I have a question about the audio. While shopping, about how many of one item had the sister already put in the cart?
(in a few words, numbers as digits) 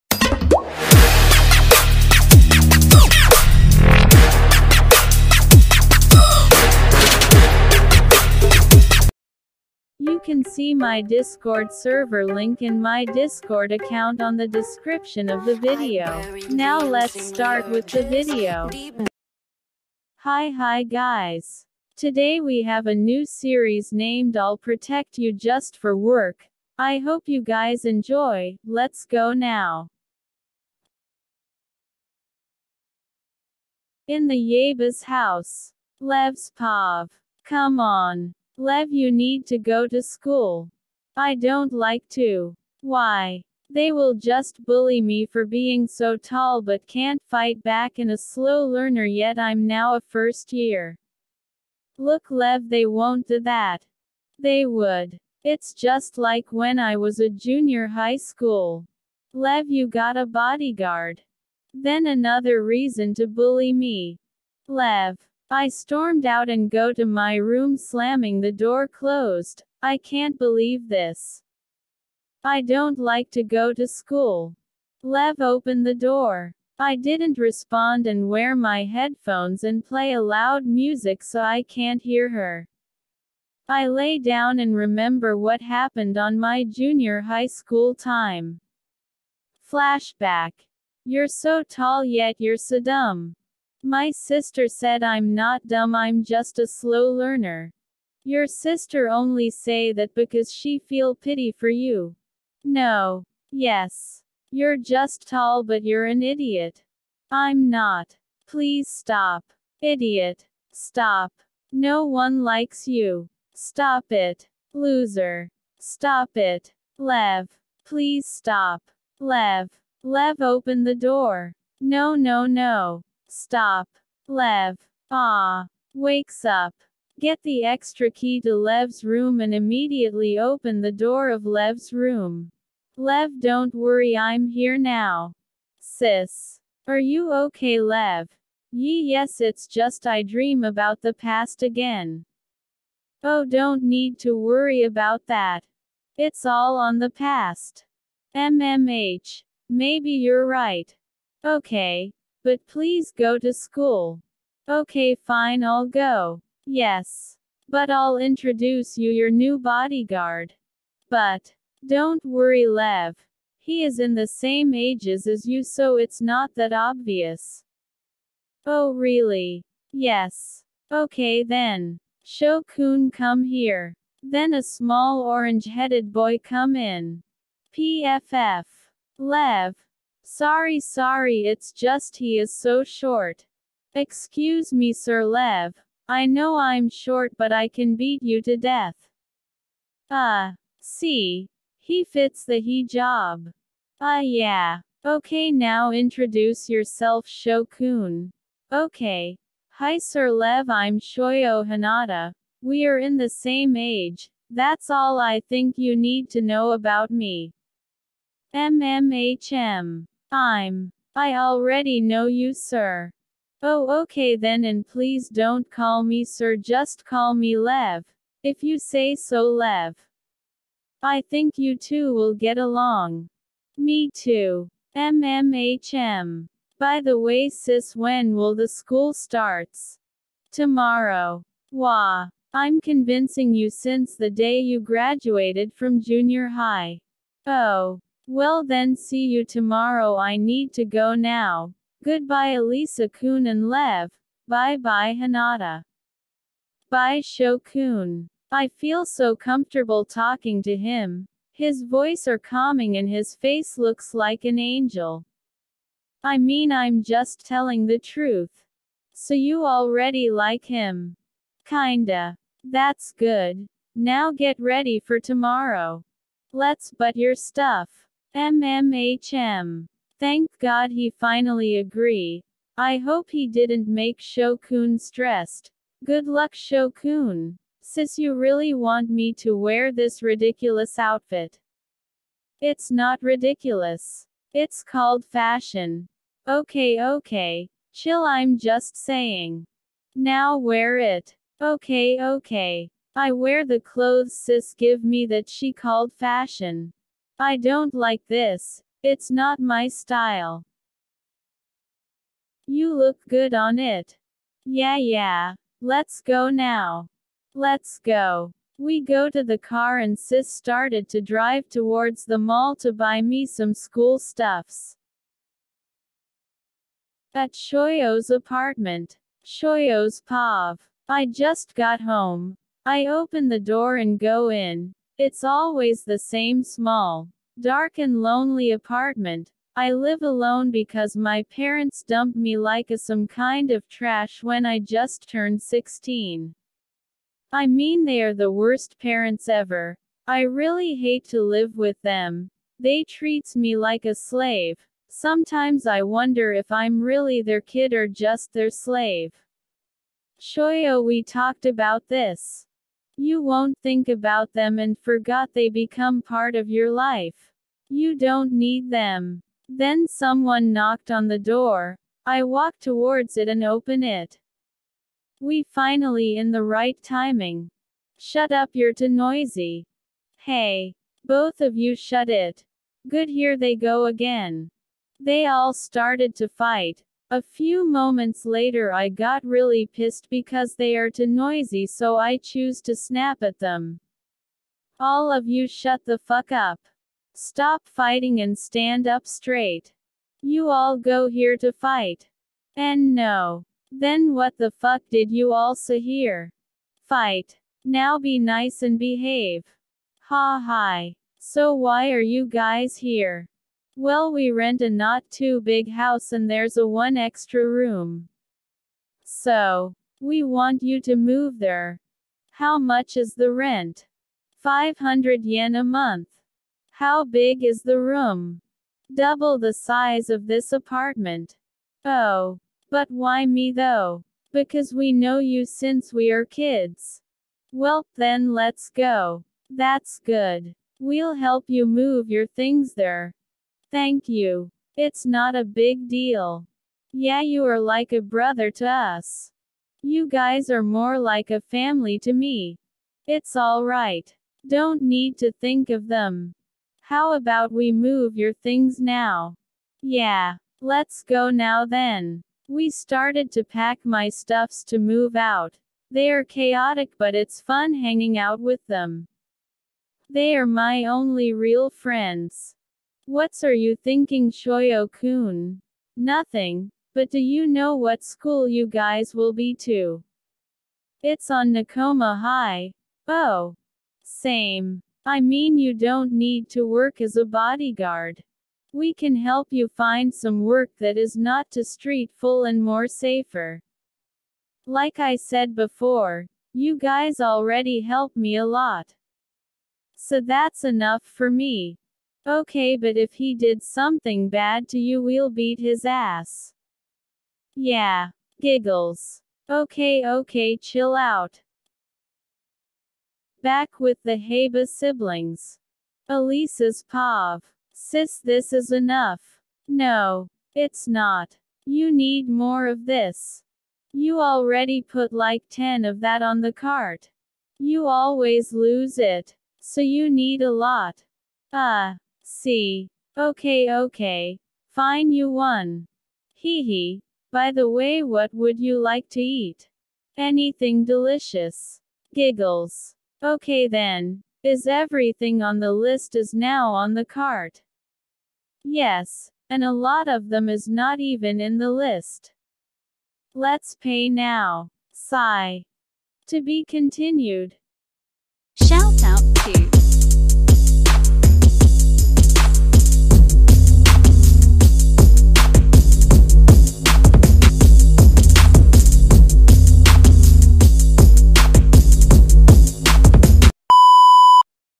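10.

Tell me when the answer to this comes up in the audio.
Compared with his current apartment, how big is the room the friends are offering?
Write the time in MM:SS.
06:59.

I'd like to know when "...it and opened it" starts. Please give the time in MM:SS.
06:03.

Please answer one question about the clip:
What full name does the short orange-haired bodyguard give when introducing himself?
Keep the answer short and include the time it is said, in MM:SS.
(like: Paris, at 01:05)
Shoyo Hinata, at 03:20.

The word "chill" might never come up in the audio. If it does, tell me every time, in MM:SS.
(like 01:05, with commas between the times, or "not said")
04:47, 08:20.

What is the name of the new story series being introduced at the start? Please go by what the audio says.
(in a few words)
I'll Protect You Just for Work.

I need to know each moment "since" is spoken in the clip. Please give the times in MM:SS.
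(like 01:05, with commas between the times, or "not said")
03:53, 07:05.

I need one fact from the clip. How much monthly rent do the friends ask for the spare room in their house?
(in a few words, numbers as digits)
500 yen.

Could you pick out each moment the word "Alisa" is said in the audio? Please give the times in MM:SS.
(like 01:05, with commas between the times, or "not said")
04:02, 08:26.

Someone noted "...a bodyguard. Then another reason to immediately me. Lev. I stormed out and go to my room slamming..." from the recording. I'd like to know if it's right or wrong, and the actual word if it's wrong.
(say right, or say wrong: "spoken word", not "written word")
wrong: "bully", not "immediately".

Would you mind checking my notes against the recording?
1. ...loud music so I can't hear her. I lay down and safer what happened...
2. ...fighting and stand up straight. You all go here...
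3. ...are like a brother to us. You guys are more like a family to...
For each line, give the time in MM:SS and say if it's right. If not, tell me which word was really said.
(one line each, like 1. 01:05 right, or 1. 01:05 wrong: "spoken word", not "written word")
1. 01:20 wrong: "remember", not "safer"
2. 06:27 right
3. 07:17 right.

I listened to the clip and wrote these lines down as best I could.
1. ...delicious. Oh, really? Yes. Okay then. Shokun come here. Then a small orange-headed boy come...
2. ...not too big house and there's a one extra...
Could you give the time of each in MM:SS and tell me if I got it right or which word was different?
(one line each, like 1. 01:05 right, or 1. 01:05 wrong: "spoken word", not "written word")
1. 02:46 wrong: "obvious", not "delicious"
2. 06:44 right.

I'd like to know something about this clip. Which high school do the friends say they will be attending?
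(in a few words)
Nekoma High.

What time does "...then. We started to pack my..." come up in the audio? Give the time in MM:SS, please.
07:31.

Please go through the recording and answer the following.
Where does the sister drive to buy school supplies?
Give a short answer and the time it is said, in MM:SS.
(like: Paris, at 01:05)
The mall, at 05:12.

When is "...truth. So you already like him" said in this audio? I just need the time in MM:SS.
04:17.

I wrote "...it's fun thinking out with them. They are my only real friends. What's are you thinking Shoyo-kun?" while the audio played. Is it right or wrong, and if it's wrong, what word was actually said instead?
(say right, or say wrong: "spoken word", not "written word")
wrong: "hanging", not "thinking".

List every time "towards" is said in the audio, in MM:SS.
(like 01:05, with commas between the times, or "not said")
05:11, 06:02.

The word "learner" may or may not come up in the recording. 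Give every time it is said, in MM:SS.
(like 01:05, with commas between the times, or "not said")
00:48, 01:37.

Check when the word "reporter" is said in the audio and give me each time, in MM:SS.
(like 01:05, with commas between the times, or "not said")
not said.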